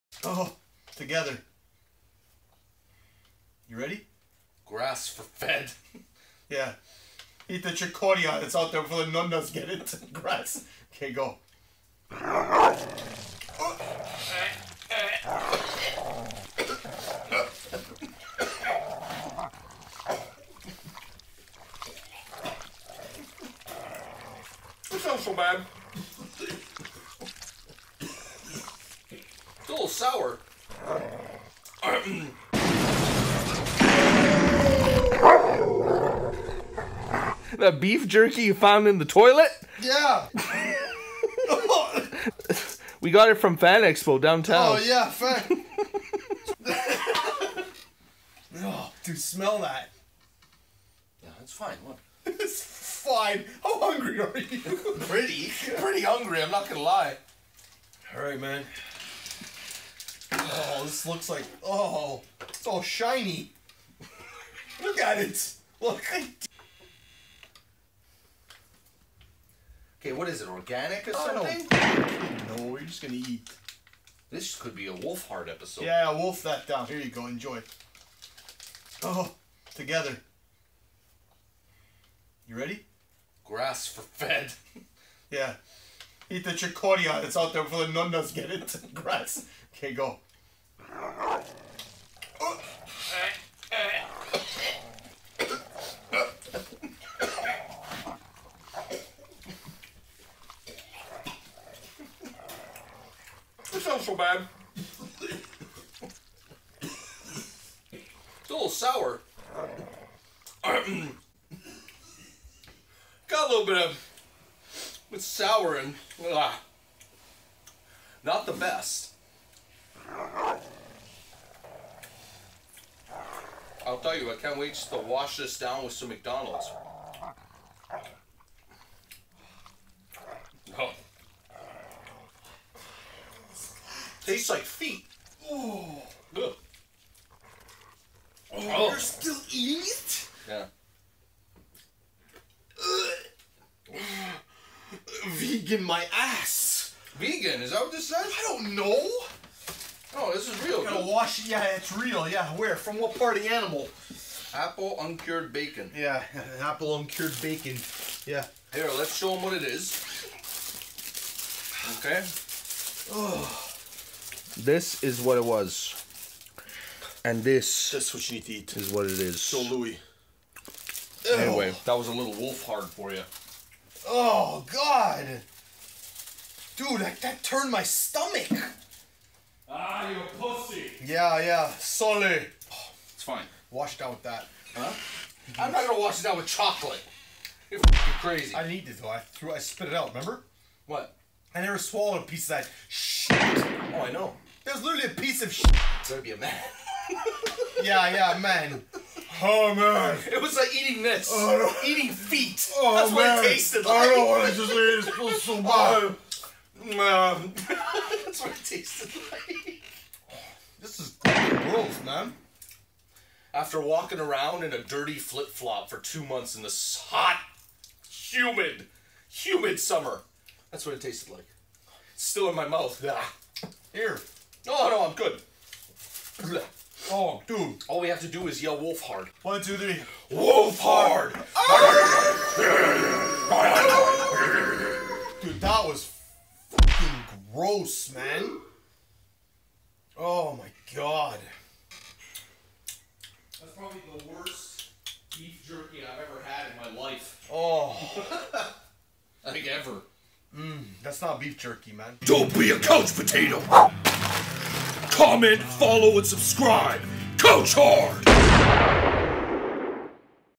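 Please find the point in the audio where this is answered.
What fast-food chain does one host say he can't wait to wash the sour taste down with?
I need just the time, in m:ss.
2:06.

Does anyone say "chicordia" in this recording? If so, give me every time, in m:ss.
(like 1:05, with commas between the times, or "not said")
0:07, 1:26.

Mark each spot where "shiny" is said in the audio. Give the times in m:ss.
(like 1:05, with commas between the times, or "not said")
1:02.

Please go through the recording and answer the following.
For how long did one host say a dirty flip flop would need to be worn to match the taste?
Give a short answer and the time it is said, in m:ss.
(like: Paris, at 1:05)
2 months, at 3:35.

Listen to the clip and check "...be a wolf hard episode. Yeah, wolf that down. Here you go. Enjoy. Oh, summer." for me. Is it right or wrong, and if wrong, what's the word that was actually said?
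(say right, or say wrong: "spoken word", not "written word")
wrong: "together", not "summer".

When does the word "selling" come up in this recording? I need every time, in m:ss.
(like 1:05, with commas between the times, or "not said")
not said.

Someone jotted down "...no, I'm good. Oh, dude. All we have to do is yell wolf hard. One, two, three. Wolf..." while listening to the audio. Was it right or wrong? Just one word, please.
right.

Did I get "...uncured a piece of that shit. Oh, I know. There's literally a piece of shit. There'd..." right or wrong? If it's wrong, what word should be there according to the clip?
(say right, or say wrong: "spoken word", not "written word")
wrong: "swallowed", not "uncured".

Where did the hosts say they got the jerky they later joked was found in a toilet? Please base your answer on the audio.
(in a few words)
Fan Expo downtown.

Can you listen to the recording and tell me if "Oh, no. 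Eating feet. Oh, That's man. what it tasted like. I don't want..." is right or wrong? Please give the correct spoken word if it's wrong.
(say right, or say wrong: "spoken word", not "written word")
right.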